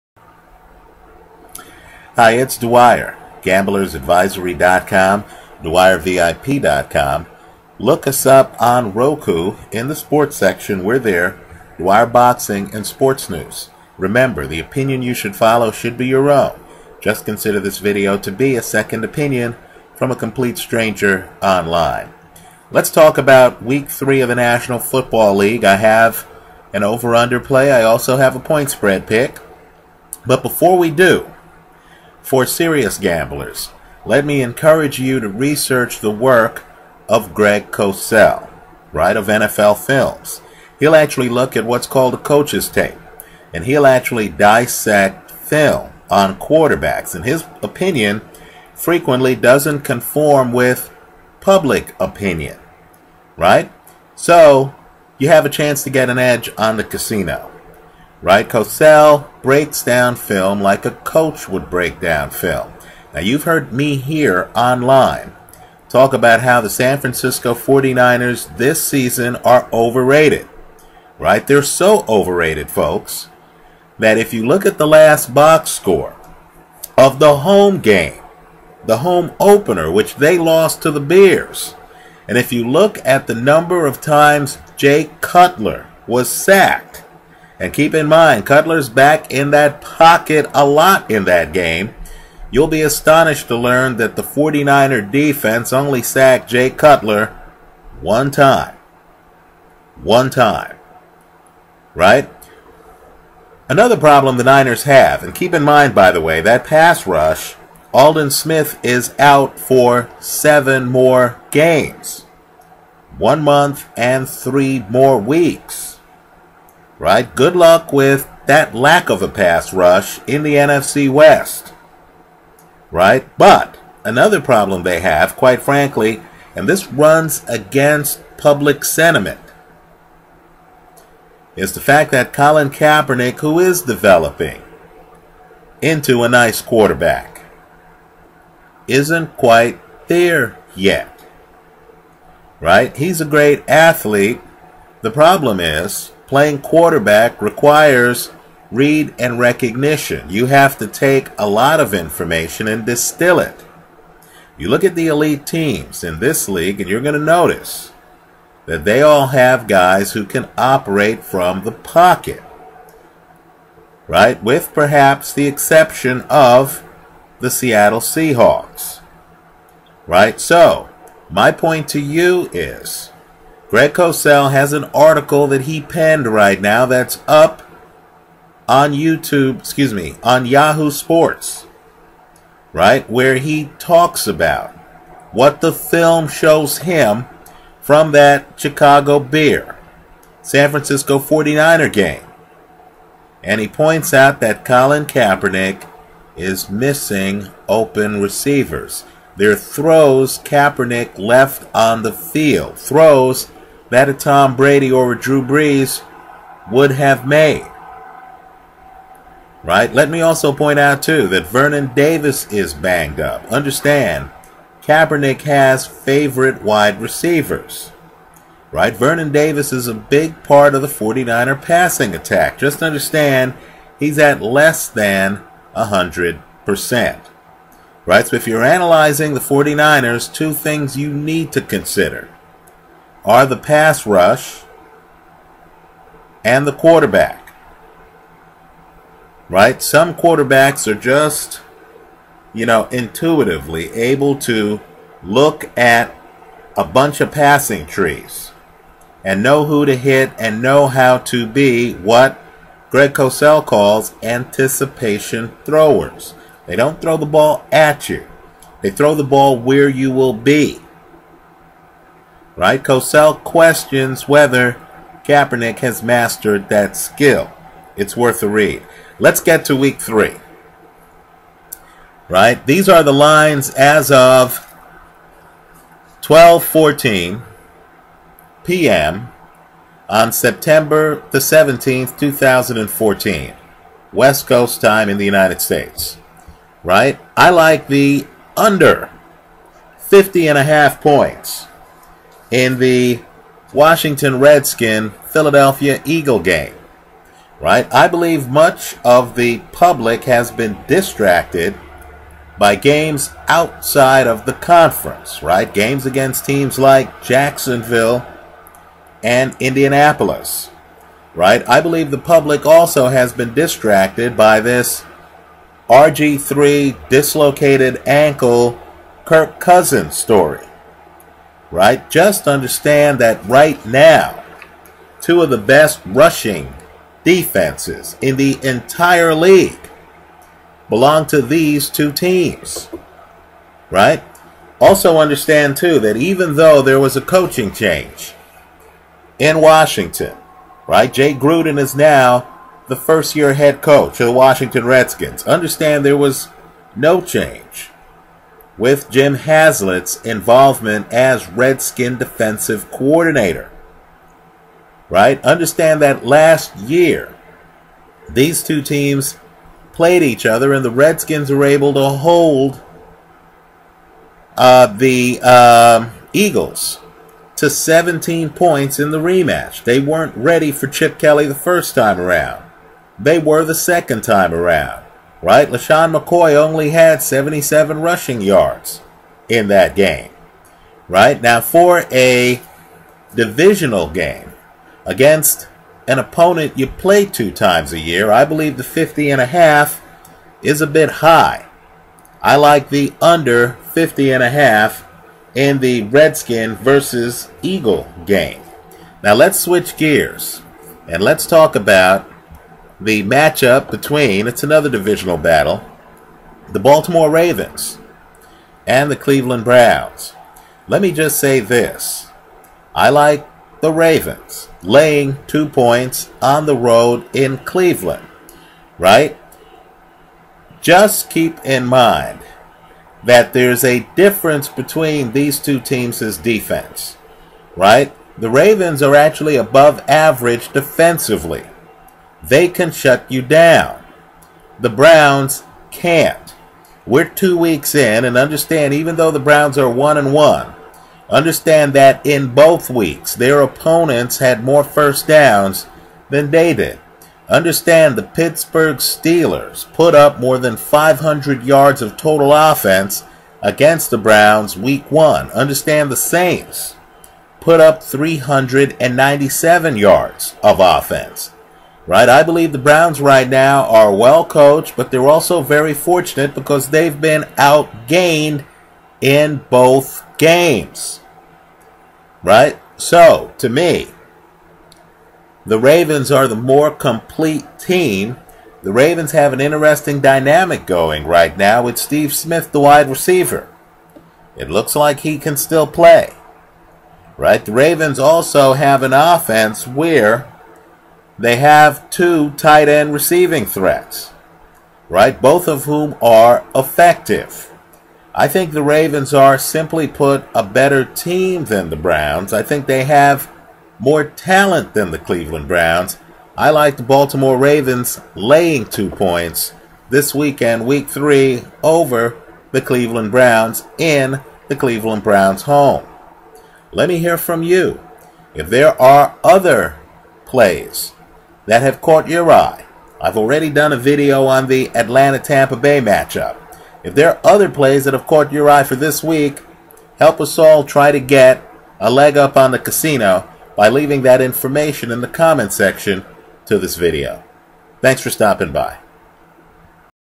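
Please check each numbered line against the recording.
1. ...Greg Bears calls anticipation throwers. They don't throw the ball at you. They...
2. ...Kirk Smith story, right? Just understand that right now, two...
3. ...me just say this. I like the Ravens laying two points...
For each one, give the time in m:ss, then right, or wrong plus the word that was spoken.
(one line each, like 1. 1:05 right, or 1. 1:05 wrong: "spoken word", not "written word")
1. 4:12 wrong: "Cosell", not "Bears"
2. 5:19 wrong: "Cousins", not "Smith"
3. 6:51 right.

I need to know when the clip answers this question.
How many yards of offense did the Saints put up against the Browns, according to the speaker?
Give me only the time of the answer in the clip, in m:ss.
7:38.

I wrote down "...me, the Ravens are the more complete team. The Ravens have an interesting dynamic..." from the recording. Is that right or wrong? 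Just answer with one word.
right.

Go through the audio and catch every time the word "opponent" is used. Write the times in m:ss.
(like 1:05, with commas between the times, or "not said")
6:26, 7:23.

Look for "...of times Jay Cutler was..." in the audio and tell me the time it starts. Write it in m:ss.
1:23.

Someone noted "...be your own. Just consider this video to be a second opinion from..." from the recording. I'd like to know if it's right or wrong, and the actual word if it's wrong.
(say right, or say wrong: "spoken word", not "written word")
right.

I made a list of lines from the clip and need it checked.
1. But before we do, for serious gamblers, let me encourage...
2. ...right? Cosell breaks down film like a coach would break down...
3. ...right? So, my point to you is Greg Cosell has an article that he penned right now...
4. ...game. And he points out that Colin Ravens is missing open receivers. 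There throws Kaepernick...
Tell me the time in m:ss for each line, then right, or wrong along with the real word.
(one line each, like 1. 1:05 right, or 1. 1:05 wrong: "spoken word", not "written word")
1. 0:30 right
2. 0:58 right
3. 2:50 right
4. 3:11 wrong: "Kaepernick", not "Ravens".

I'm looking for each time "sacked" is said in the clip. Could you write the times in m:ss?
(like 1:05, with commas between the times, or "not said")
1:26, 1:36.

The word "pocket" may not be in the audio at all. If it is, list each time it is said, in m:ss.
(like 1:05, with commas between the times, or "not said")
1:29, 2:41.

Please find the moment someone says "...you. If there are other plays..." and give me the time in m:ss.
8:37.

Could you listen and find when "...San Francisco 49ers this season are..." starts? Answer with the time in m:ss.
1:06.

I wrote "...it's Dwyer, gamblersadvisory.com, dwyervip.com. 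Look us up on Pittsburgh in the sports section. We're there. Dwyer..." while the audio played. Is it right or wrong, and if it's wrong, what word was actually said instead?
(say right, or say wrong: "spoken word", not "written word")
wrong: "Roku", not "Pittsburgh".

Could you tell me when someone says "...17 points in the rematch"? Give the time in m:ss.
6:07.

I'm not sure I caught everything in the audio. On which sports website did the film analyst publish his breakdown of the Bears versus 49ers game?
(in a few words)
Yahoo Sports.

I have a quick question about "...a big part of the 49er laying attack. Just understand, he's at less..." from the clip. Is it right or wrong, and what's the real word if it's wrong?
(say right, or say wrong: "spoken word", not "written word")
wrong: "passing", not "laying".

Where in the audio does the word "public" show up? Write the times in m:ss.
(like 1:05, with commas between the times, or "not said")
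0:51, 2:08, 4:59, 5:12.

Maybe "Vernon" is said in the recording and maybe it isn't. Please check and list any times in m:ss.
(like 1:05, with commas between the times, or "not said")
3:31, 3:38.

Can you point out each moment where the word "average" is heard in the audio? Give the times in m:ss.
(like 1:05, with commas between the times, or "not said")
7:10.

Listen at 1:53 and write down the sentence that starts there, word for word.
One month and three more weeks right?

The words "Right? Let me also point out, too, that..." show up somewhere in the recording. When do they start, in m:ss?
3:29.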